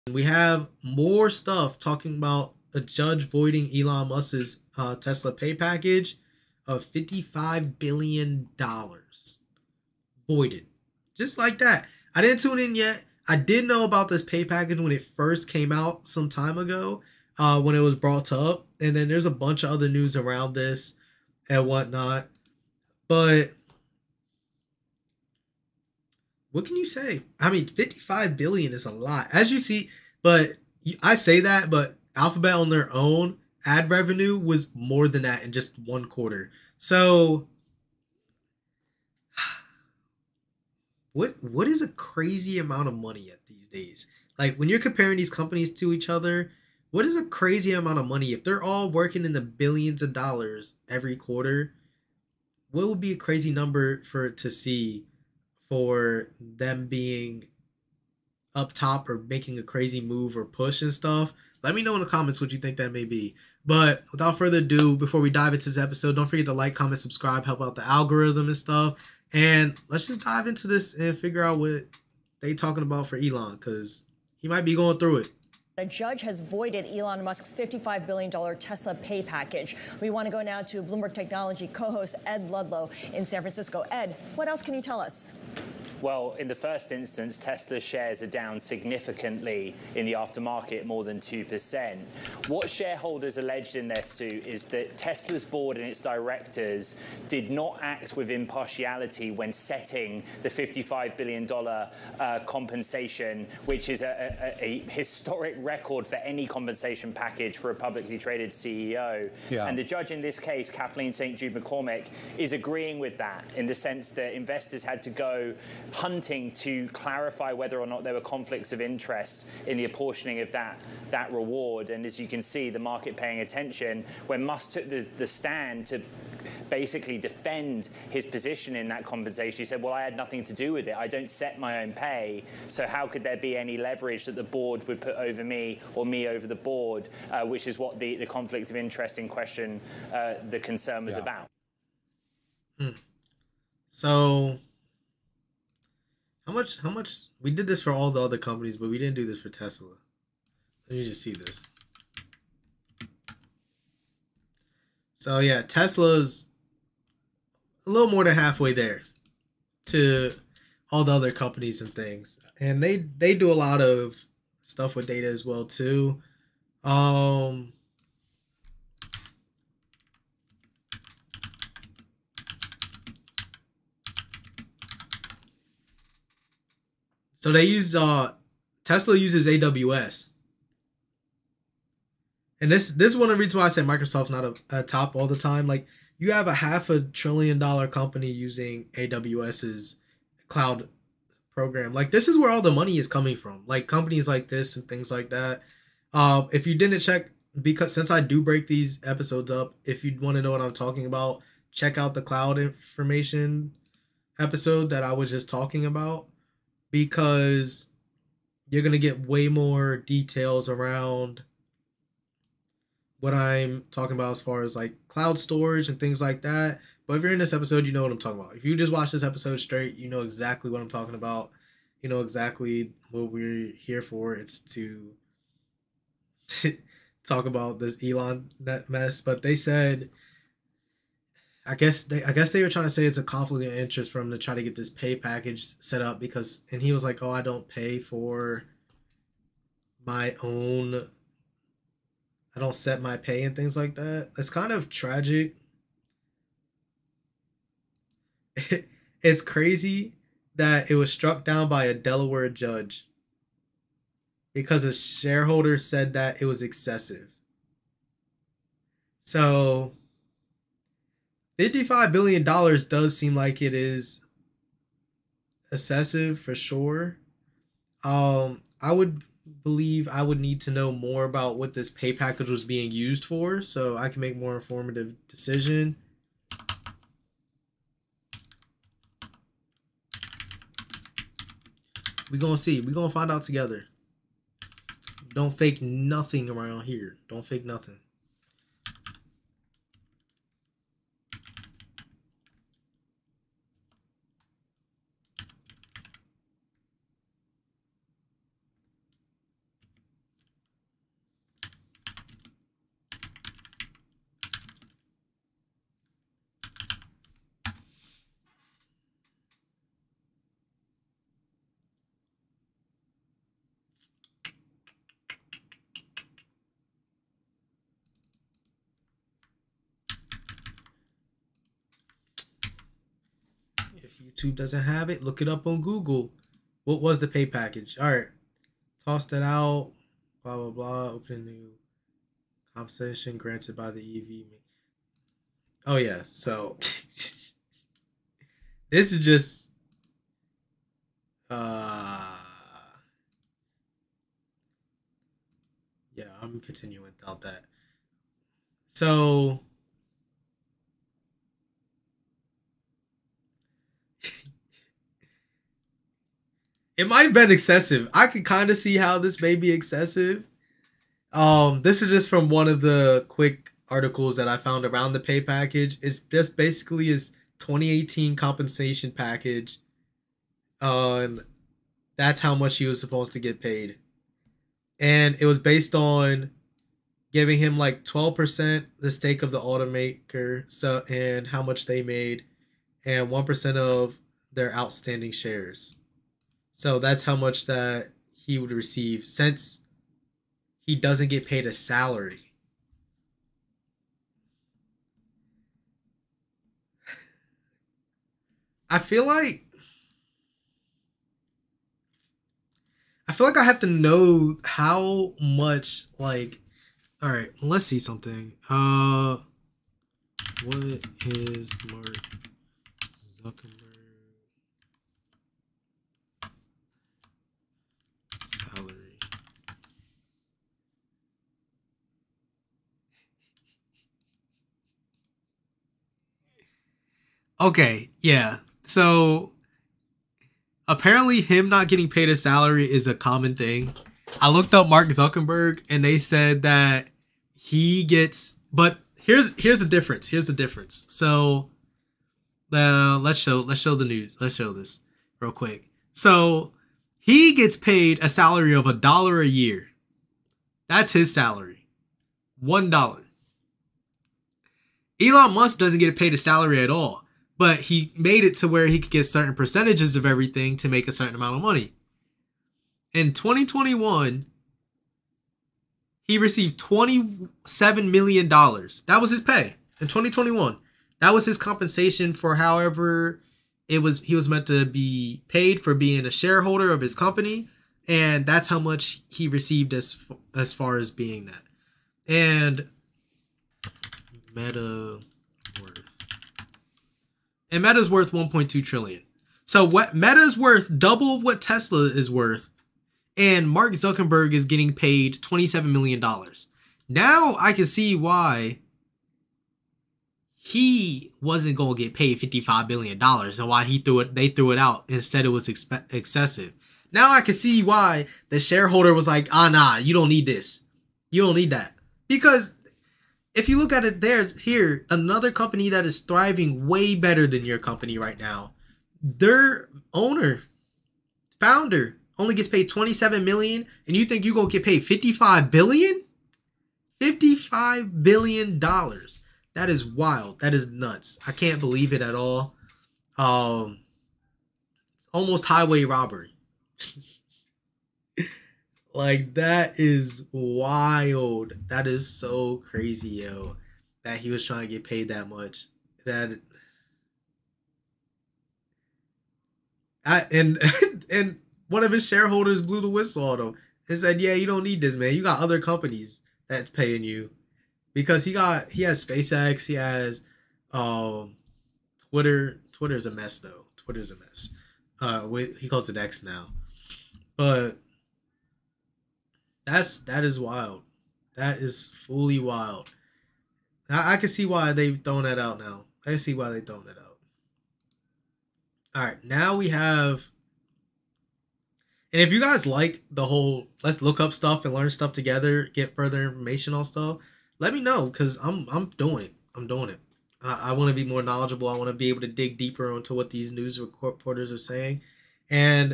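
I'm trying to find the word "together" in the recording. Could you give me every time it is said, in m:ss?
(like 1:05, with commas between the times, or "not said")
4:43, 9:45.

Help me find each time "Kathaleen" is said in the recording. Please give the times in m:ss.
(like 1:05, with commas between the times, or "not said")
1:50.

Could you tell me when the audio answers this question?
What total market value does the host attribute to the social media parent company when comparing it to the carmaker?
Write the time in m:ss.
8:08.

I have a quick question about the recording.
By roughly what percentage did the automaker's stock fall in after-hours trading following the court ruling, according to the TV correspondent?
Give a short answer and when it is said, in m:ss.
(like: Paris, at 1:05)
2%, at 1:30.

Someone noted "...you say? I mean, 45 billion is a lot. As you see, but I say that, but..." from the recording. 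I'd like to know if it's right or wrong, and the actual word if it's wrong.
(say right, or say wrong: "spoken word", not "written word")
wrong: "55", not "45".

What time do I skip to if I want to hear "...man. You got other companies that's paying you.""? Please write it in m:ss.
9:15.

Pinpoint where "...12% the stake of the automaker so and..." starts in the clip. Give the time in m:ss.
6:18.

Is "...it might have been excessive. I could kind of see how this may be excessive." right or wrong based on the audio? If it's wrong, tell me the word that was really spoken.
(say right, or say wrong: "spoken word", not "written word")
right.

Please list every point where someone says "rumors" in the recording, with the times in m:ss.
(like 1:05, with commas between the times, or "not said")
not said.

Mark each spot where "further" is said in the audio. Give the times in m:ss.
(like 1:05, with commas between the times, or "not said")
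1:04, 9:46.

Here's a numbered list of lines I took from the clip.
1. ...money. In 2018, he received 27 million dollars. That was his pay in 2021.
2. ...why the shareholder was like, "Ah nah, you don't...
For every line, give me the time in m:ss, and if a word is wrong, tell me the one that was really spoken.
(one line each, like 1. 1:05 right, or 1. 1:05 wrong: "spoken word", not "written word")
1. 7:41 wrong: "2021", not "2018"
2. 8:27 right.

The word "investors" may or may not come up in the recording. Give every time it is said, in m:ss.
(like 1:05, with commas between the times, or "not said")
1:54.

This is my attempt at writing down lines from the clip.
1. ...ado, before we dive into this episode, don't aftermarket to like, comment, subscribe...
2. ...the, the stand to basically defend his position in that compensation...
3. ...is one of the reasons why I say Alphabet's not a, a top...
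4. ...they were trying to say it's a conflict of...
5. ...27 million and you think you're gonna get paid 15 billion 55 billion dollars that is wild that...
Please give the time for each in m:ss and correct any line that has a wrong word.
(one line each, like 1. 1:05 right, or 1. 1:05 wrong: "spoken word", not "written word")
1. 1:04 wrong: "forget", not "aftermarket"
2. 2:04 right
3. 3:03 wrong: "Microsoft", not "Alphabet"
4. 3:52 right
5. 8:42 wrong: "55", not "15".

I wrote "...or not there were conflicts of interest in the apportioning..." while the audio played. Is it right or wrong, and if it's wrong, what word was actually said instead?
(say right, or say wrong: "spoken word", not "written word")
right.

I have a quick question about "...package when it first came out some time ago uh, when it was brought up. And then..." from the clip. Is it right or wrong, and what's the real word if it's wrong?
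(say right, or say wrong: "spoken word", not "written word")
right.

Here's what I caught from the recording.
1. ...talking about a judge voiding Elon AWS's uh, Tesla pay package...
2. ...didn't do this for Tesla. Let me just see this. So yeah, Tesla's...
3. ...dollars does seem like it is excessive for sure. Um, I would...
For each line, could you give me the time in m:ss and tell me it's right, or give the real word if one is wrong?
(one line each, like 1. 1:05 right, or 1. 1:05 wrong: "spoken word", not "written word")
1. 0:01 wrong: "Musk", not "AWS"
2. 2:28 right
3. 4:22 right.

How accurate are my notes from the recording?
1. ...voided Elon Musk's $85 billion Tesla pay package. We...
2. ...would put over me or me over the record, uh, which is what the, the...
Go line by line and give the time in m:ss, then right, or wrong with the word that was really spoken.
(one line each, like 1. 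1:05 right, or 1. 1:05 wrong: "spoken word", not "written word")
1. 1:16 wrong: "55", not "85"
2. 2:14 wrong: "board", not "record".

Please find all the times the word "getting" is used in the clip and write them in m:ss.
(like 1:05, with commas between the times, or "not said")
7:11, 8:14.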